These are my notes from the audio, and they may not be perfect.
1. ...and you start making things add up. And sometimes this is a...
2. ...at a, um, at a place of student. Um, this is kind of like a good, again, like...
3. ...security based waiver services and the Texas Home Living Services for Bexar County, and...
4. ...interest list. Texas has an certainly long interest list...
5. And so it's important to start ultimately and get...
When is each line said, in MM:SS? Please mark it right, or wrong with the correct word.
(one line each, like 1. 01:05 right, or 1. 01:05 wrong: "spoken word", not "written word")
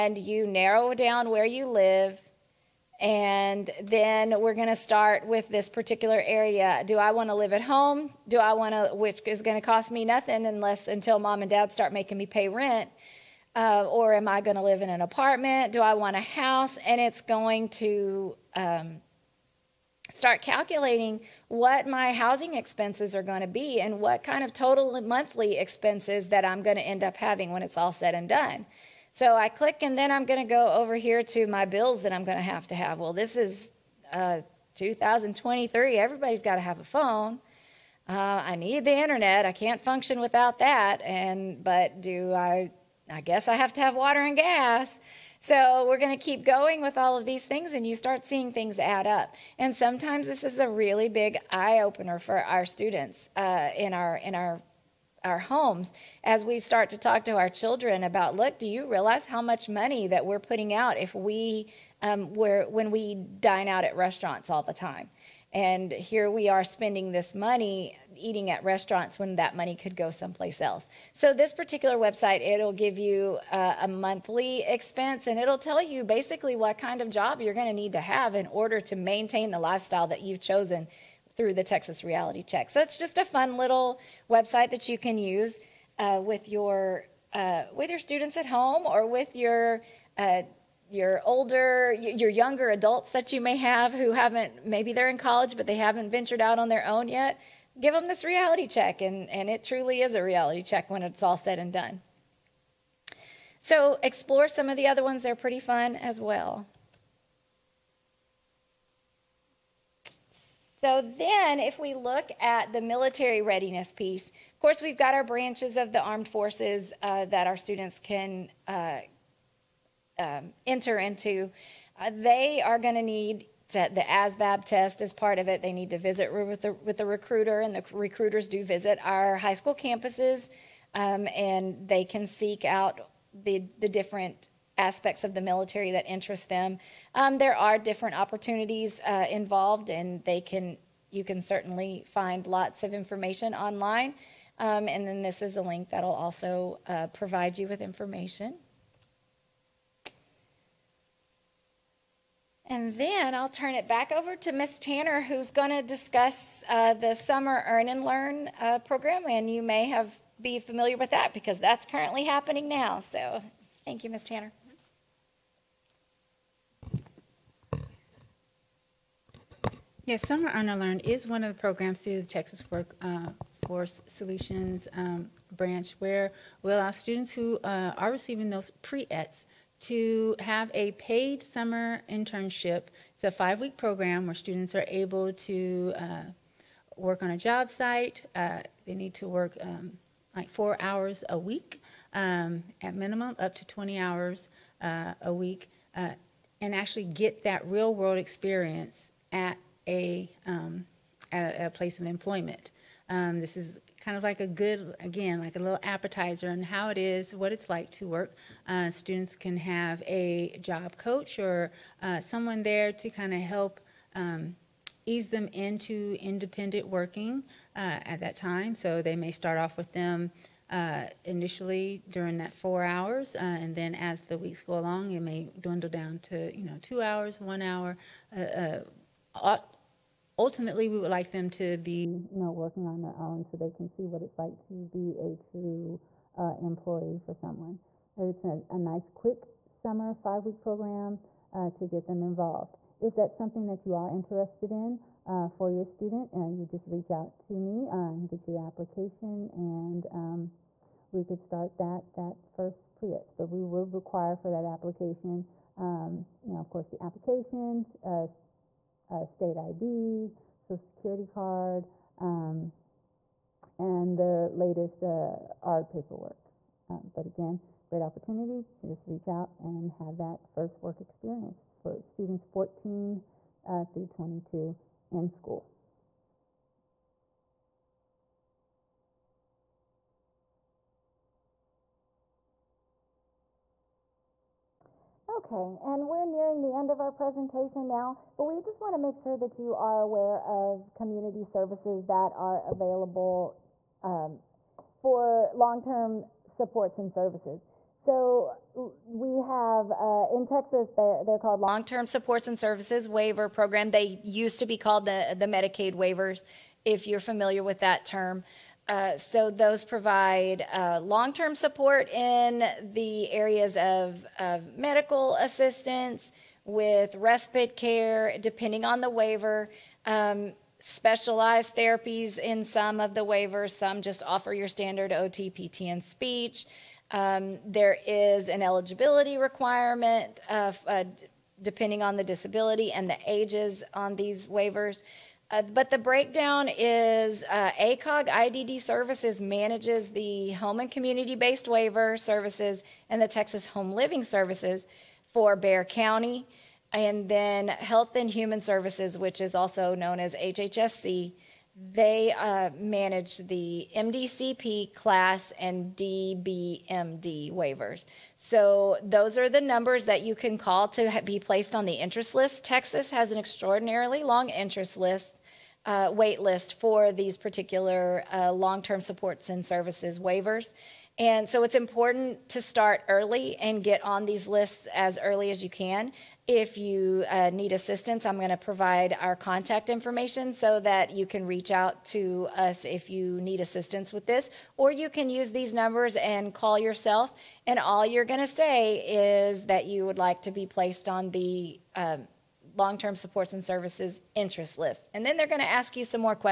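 1. 00:47 wrong: "seeing", not "making"
2. 03:19 wrong: "employment", not "student"
3. 05:40 wrong: "community", not "security"
4. 06:01 wrong: "extraordinarily", not "certainly"
5. 06:11 wrong: "early", not "ultimately".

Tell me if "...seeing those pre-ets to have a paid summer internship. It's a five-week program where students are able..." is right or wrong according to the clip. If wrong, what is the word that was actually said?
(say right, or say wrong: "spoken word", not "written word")
wrong: "receiving", not "seeing".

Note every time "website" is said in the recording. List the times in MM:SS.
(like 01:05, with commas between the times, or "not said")
01:11, 01:24.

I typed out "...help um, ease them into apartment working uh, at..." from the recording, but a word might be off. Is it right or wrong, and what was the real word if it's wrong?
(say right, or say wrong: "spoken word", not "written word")
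wrong: "independent", not "apartment".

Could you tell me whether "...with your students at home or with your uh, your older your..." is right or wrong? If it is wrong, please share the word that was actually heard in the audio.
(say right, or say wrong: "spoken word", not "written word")
right.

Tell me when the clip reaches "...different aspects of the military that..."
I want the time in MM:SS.
02:13.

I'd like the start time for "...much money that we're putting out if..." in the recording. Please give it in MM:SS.
00:59.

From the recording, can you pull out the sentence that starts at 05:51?
They uh, manage the MDCP CLASS and DBMD waivers.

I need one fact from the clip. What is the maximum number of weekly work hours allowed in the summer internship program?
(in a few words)
20.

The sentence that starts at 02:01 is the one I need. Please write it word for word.
Uh, they are going to need the ASVAB test as part of it.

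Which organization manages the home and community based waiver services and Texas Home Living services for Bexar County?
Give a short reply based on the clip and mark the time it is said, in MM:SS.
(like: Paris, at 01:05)
AACOG IDD Services, at 05:37.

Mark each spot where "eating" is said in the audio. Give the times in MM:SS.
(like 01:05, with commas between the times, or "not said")
01:08.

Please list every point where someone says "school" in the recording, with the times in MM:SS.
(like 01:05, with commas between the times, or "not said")
02:09, 04:35.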